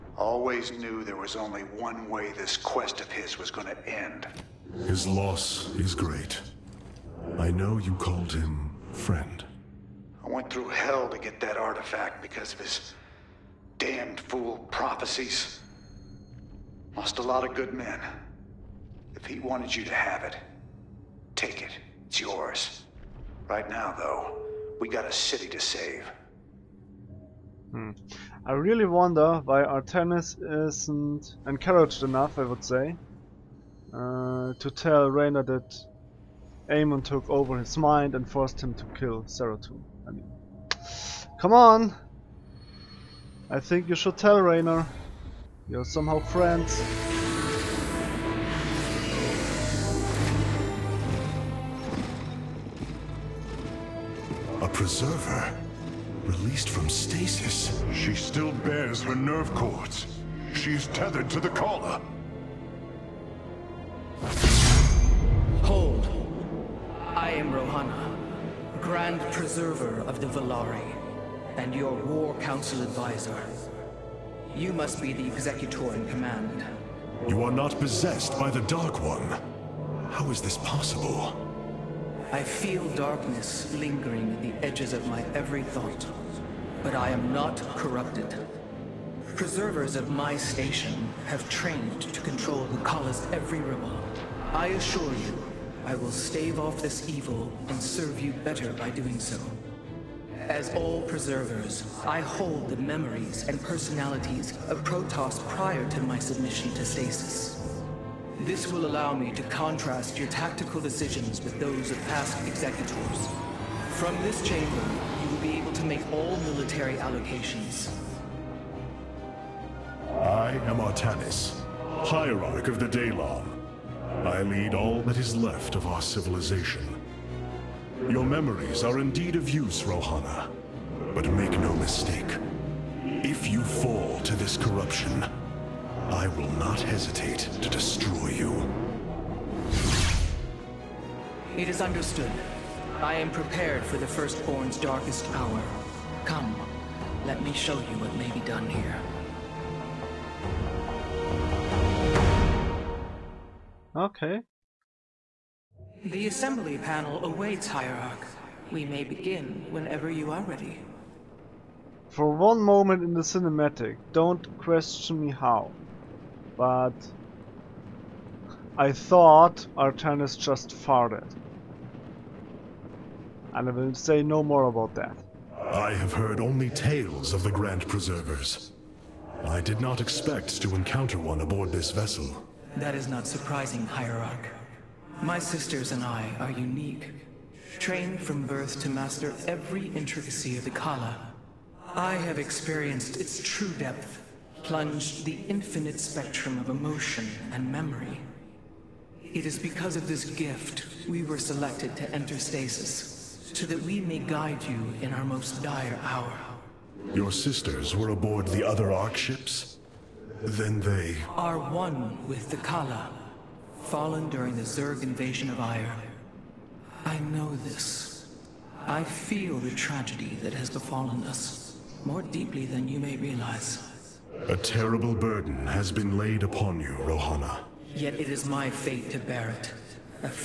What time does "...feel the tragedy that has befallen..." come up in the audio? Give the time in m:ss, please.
3:39.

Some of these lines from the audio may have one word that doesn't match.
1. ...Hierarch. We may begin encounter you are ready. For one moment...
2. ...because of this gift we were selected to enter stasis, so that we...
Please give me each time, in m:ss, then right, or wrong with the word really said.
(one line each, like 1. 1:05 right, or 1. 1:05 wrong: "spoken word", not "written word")
1. 2:37 wrong: "whenever", not "encounter"
2. 3:19 right.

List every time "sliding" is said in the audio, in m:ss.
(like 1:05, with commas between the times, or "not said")
not said.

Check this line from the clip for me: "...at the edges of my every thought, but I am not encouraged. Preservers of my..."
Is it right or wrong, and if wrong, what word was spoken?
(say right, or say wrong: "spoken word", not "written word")
wrong: "corrupted", not "encouraged".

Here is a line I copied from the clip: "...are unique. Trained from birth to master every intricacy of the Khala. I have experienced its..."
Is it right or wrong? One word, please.
right.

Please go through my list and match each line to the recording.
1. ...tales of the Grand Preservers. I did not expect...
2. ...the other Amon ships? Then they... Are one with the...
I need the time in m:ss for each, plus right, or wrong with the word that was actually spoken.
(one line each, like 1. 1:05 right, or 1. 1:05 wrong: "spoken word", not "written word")
1. 2:56 right
2. 3:28 wrong: "Ark", not "Amon".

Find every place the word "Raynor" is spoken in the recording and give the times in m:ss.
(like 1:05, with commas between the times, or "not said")
0:35, 0:44.